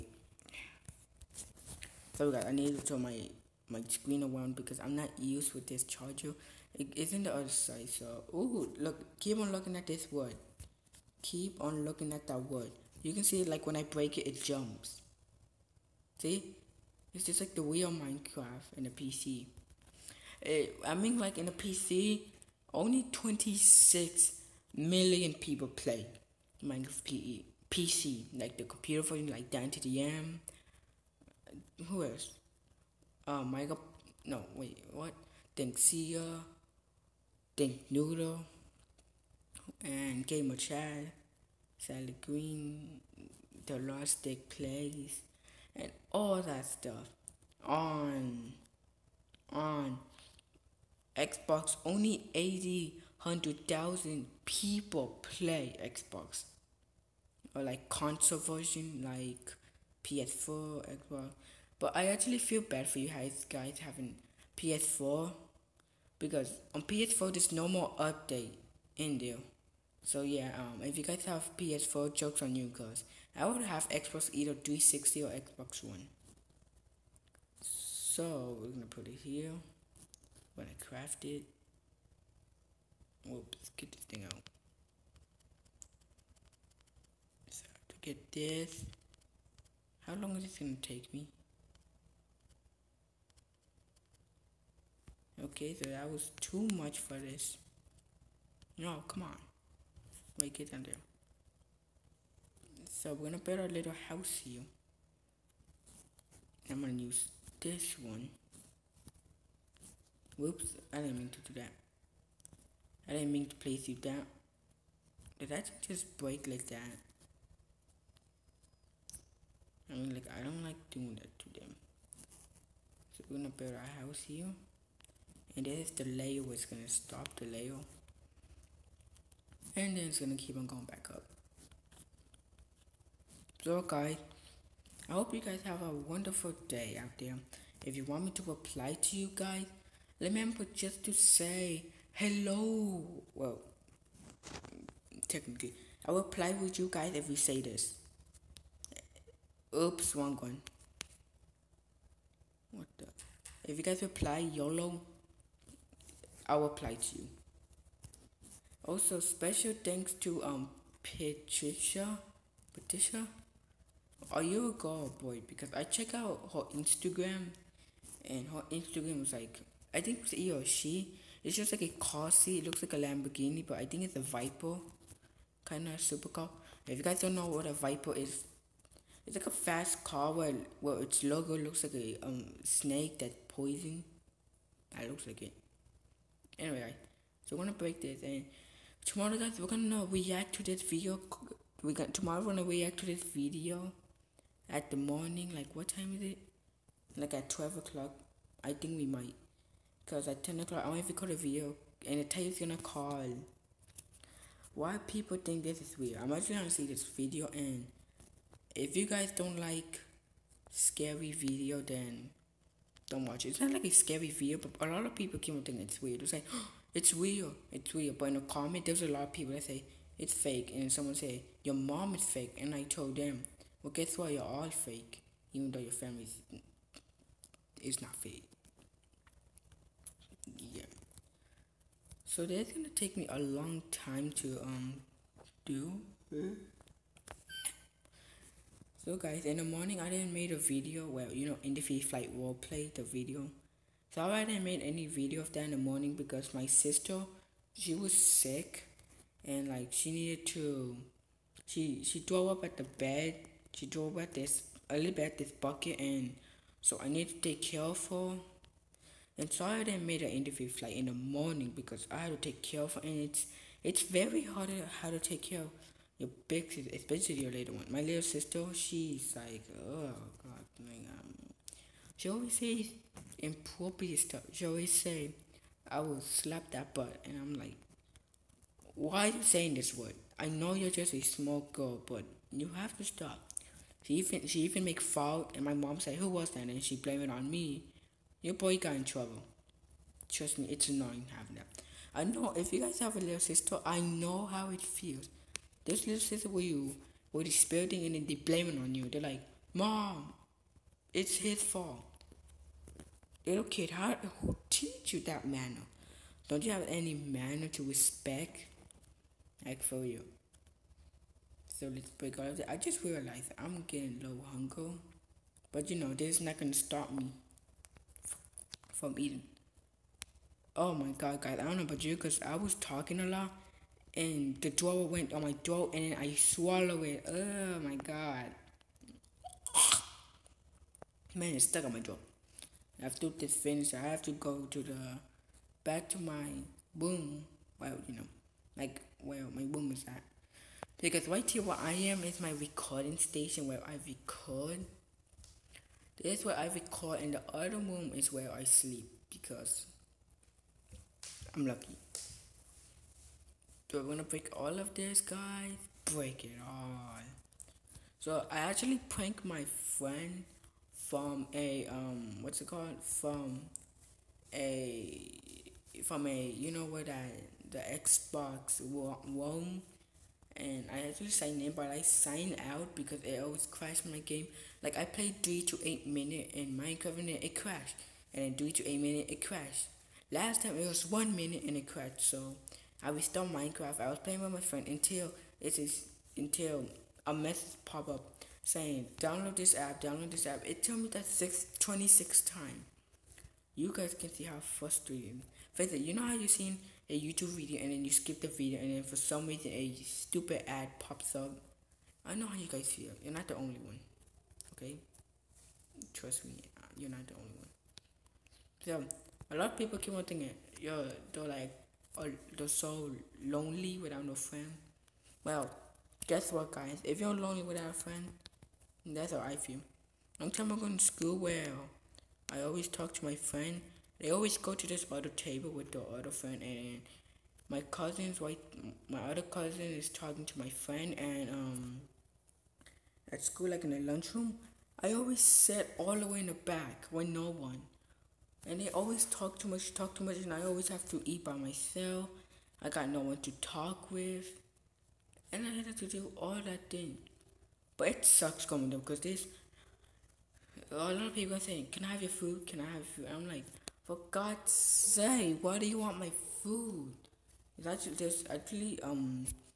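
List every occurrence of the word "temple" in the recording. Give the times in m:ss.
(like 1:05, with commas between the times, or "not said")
not said.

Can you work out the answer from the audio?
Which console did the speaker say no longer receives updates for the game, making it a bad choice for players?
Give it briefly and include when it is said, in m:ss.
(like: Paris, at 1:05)
PS4, at 1:06.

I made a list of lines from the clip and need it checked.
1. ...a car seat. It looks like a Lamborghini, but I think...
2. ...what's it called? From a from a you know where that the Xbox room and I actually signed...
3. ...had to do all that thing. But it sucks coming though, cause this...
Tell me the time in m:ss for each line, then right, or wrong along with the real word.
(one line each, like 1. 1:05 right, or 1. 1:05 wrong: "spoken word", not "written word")
1. 2:51 right
2. 6:02 right
3. 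7:25 right.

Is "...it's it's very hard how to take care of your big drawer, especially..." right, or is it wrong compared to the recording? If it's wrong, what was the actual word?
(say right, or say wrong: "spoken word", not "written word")
wrong: "sister", not "drawer".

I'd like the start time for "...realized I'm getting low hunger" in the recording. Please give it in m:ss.
5:13.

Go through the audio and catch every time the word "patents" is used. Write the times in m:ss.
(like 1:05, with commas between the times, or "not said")
not said.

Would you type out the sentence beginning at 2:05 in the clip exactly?
And this is the layer it's gonna stop the layer.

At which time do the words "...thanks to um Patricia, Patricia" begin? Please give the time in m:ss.
2:39.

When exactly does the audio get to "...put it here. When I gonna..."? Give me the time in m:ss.
1:18.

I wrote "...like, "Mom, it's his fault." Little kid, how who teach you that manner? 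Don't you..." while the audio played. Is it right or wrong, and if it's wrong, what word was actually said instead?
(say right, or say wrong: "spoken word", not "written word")
right.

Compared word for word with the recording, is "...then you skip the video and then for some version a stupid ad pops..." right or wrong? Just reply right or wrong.
wrong.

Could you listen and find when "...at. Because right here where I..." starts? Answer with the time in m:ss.
5:40.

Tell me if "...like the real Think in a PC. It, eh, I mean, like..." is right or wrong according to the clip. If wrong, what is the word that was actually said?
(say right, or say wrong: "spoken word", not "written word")
wrong: "Minecraft", not "Think".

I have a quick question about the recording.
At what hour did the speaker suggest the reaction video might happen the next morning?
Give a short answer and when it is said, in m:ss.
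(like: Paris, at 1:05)
12 o'clock, at 3:17.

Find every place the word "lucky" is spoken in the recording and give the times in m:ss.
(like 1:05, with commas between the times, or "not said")
5:51.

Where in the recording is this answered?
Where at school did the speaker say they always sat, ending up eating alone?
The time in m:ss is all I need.
7:15.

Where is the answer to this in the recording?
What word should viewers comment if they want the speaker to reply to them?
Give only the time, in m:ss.
2:34.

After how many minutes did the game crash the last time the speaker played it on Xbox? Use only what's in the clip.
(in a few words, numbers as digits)
1 minute.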